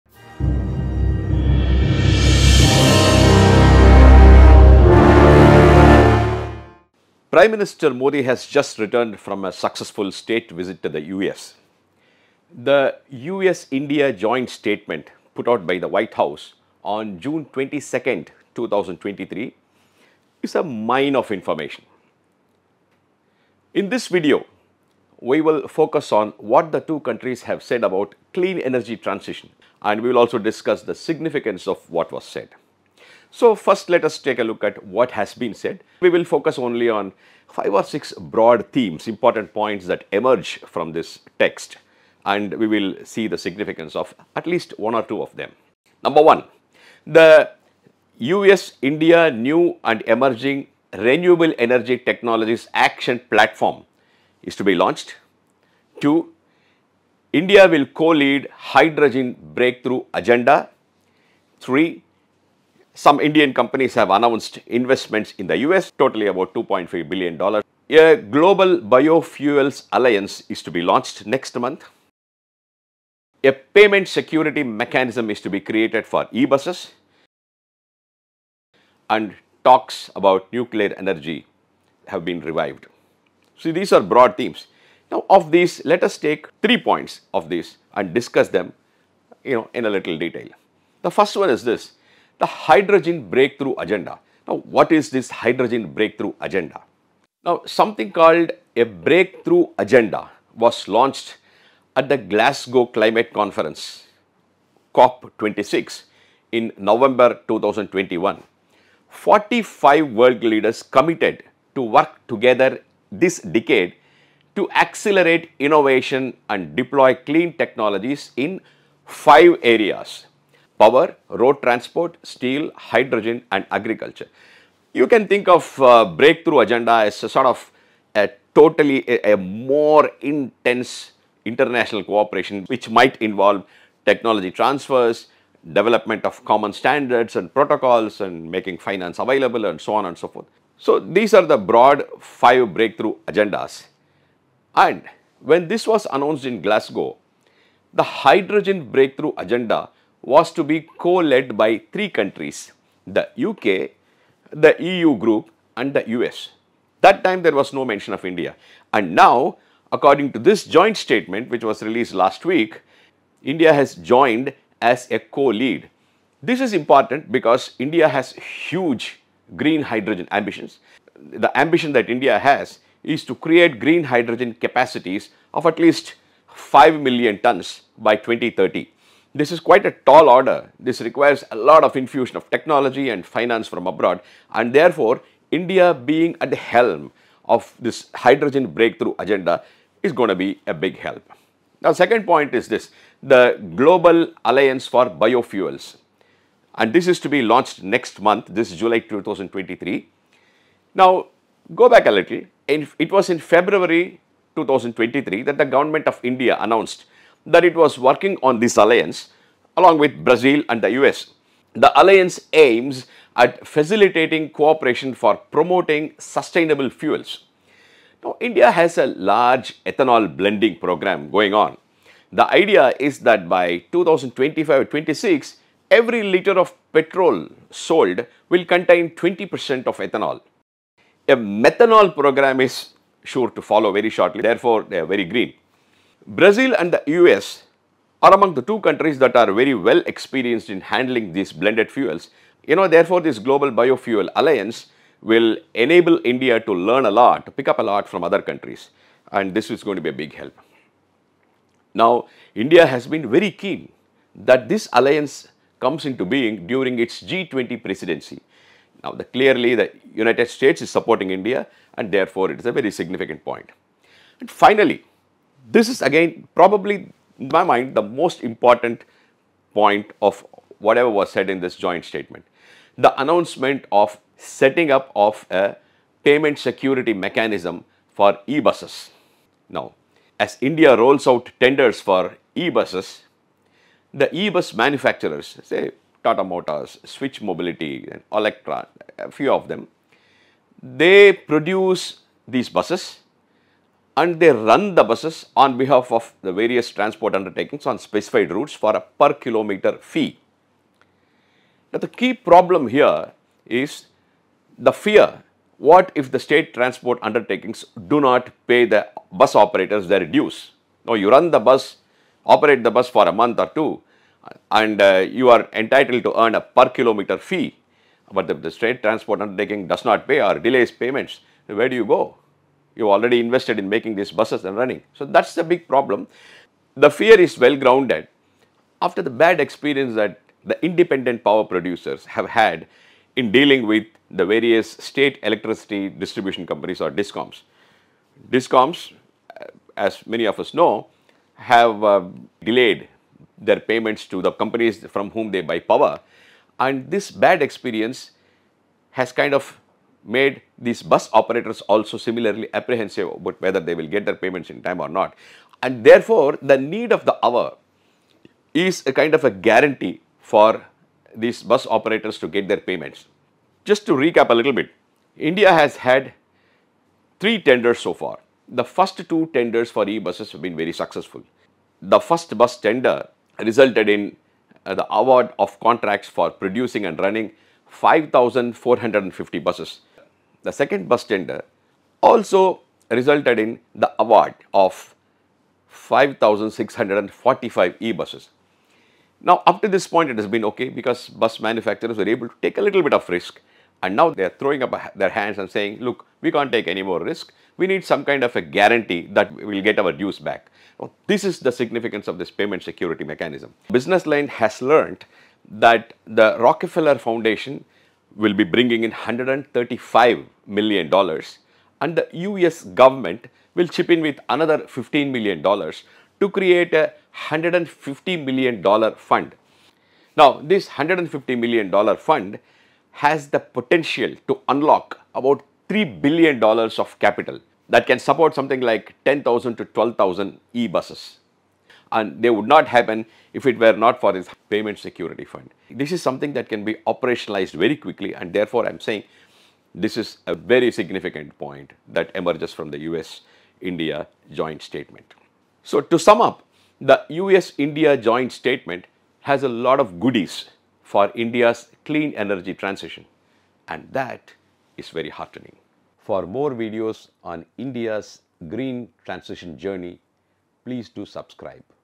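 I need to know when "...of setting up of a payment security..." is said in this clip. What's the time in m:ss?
4:33.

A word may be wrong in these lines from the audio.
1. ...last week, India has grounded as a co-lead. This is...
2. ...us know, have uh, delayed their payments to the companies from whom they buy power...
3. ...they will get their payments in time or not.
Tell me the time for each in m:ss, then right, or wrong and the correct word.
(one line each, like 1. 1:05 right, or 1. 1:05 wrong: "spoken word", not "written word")
1. 2:42 wrong: "joined", not "grounded"
2. 5:40 right
3. 5:53 right.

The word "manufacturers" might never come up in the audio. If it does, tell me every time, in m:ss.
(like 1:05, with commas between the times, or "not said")
4:44, 6:31.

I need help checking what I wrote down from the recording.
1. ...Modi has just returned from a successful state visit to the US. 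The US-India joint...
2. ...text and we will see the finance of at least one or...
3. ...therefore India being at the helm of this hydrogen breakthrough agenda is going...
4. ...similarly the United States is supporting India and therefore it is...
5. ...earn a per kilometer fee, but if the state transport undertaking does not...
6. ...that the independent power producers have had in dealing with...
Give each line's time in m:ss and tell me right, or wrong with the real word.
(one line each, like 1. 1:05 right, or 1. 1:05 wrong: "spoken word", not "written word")
1. 0:07 right
2. 0:41 wrong: "significance", not "finance"
3. 3:04 right
4. 4:19 wrong: "clearly", not "similarly"
5. 5:16 right
6. 5:30 right.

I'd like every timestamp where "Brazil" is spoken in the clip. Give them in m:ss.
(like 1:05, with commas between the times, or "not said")
3:30, 3:56.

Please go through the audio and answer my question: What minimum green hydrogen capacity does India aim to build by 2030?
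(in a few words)
5 million tons.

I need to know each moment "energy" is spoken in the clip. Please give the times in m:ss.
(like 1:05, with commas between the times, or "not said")
0:28, 0:51, 1:20, 7:32.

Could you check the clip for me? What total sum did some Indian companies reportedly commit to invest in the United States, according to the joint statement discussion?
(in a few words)
$2.5 billion.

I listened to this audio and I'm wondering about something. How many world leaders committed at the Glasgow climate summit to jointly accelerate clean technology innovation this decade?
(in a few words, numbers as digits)
45.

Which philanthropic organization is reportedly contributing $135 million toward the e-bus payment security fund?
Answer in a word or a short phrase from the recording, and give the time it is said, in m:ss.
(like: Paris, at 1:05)
Rockefeller Foundation, at 6:46.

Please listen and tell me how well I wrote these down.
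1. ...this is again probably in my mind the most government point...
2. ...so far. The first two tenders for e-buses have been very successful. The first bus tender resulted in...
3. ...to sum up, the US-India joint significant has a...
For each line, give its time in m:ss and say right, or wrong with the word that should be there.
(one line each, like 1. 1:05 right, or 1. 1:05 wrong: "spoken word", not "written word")
1. 4:25 wrong: "important", not "government"
2. 6:07 right
3. 7:26 wrong: "statement", not "significant".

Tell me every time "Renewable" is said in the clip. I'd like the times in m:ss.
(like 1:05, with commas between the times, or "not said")
0:50.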